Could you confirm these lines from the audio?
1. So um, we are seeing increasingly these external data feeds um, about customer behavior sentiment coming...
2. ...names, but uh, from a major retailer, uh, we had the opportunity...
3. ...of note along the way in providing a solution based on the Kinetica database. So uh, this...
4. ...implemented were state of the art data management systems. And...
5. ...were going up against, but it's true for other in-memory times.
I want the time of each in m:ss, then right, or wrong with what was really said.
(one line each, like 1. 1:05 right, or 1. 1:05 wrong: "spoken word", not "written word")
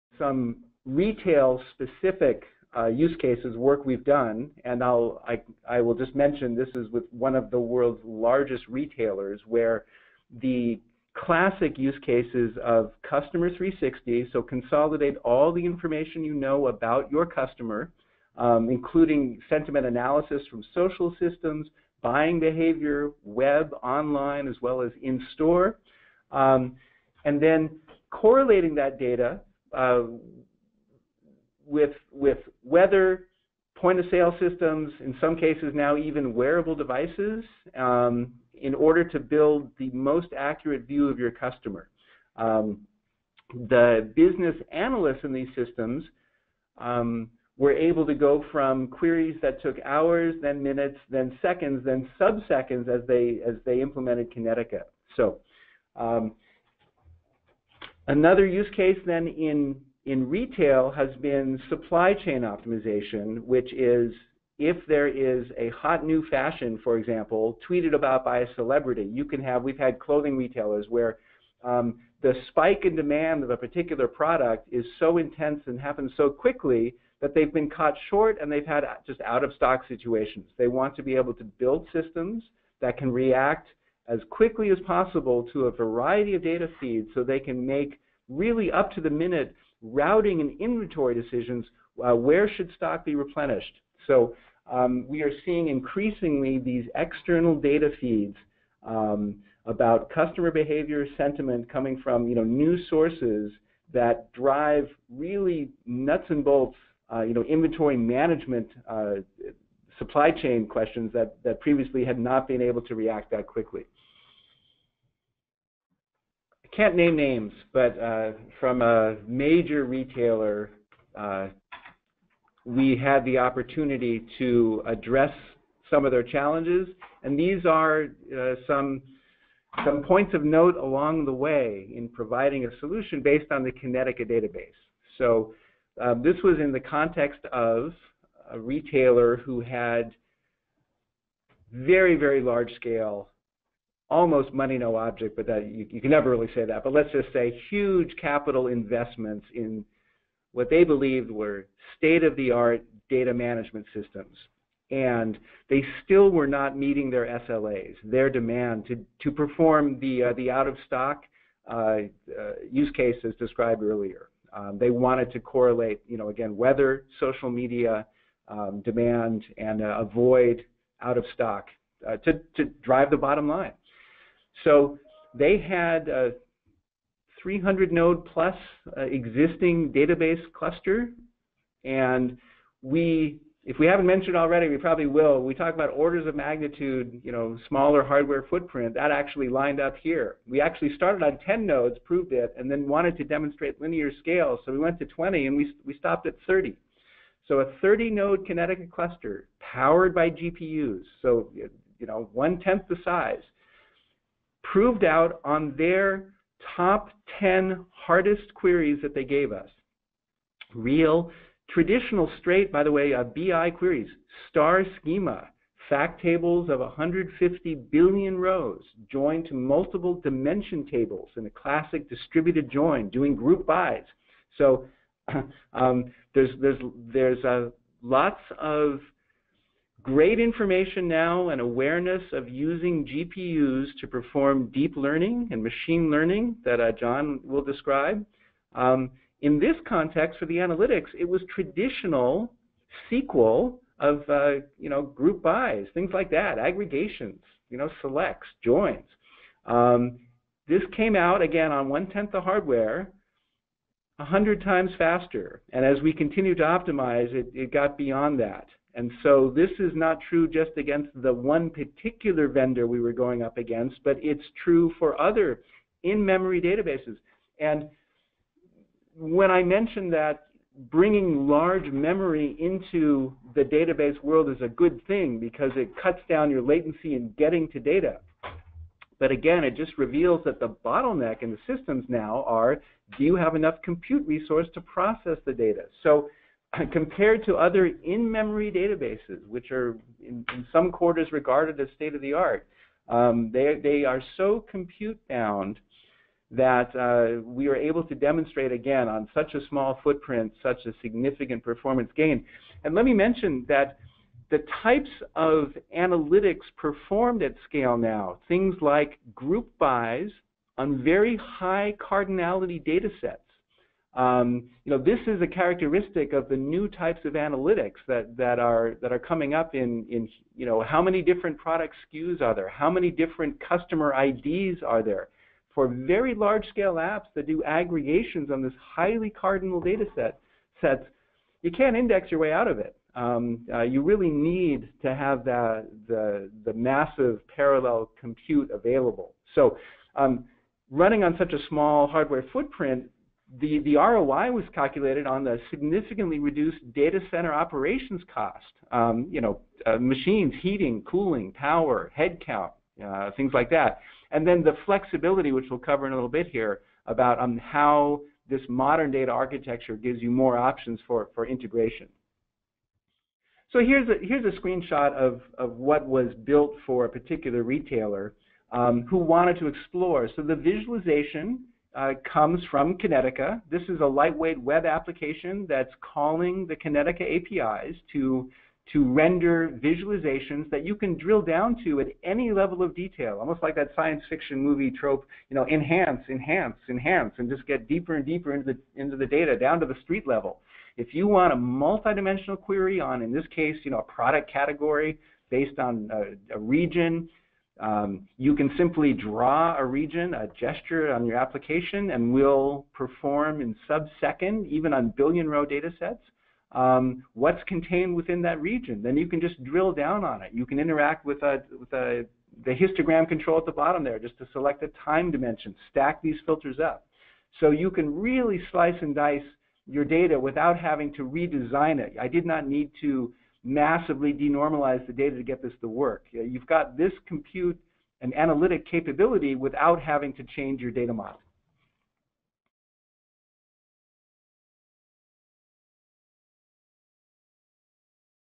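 1. 1:34 right
2. 1:57 right
3. 2:10 right
4. 2:30 wrong: "believed", not "implemented"
5. 4:22 wrong: "databases", not "times".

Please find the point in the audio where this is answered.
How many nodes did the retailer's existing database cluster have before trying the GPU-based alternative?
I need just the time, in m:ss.
2:57.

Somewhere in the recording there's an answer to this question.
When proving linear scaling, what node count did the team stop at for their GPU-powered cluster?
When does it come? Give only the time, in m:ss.
3:16.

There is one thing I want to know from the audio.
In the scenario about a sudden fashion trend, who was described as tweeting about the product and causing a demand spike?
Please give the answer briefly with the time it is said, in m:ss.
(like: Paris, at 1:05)
a celebrity, at 1:08.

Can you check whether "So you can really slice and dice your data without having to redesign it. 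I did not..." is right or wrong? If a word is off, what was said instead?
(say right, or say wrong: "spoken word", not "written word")
right.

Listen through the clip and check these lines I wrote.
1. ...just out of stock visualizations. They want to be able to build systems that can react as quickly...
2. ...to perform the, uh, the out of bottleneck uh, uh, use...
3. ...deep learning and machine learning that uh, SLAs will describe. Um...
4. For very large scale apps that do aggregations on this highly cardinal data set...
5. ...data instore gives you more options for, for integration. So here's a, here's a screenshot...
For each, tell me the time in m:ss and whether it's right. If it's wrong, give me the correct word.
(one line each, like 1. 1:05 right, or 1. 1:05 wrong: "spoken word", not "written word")
1. 1:19 wrong: "situations", not "visualizations"
2. 2:39 wrong: "stock", not "bottleneck"
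3. 3:54 wrong: "John", not "SLAs"
4. 5:25 right
5. 5:59 wrong: "architecture", not "instore".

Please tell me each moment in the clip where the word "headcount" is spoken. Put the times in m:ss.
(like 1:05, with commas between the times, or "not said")
5:52.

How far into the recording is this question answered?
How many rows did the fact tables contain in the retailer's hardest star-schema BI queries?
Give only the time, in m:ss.
3:36.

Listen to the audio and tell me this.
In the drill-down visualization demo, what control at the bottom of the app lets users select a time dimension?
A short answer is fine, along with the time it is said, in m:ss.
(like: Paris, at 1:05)
histogram control, at 6:52.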